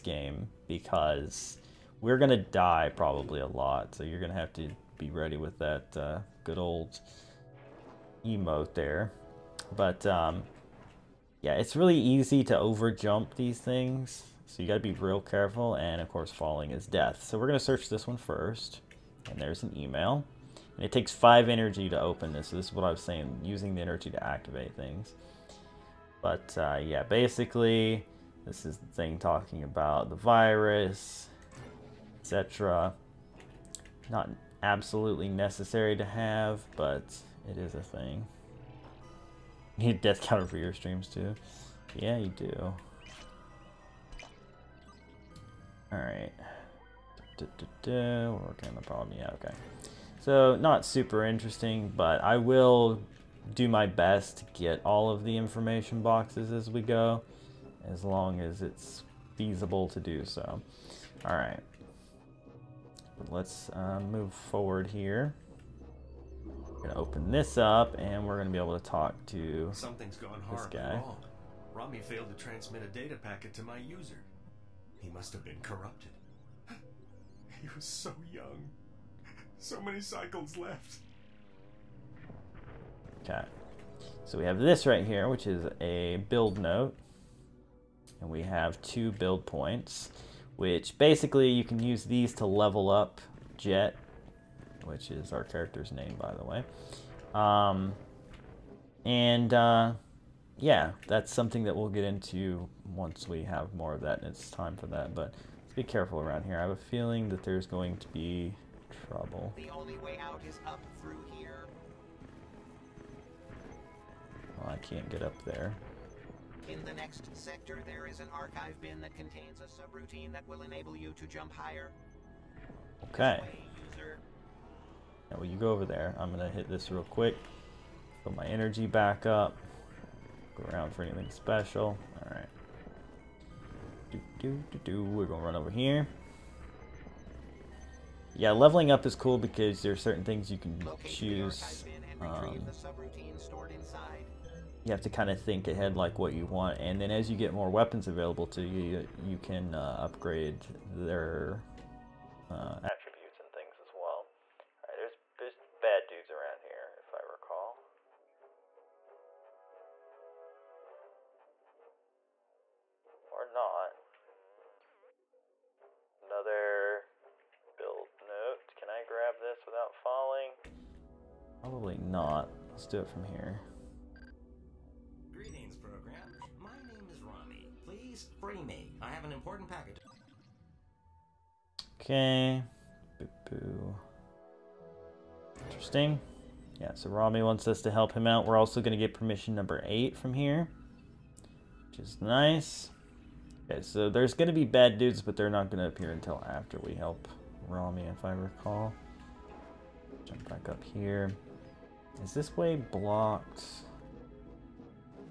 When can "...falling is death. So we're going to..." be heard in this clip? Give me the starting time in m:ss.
0:16.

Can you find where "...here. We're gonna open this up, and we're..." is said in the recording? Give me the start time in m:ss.
1:04.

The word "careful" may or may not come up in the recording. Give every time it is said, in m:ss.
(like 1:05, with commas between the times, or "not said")
0:15, 1:45.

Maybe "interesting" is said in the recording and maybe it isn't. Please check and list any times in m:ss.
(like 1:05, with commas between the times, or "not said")
0:51, 3:05.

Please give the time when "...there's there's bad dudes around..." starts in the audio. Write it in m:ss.
2:34.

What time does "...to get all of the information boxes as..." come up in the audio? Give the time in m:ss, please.
0:54.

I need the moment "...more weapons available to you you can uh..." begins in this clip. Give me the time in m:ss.
2:27.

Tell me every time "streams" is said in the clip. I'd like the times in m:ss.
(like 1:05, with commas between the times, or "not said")
0:40.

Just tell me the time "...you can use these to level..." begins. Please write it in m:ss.
1:31.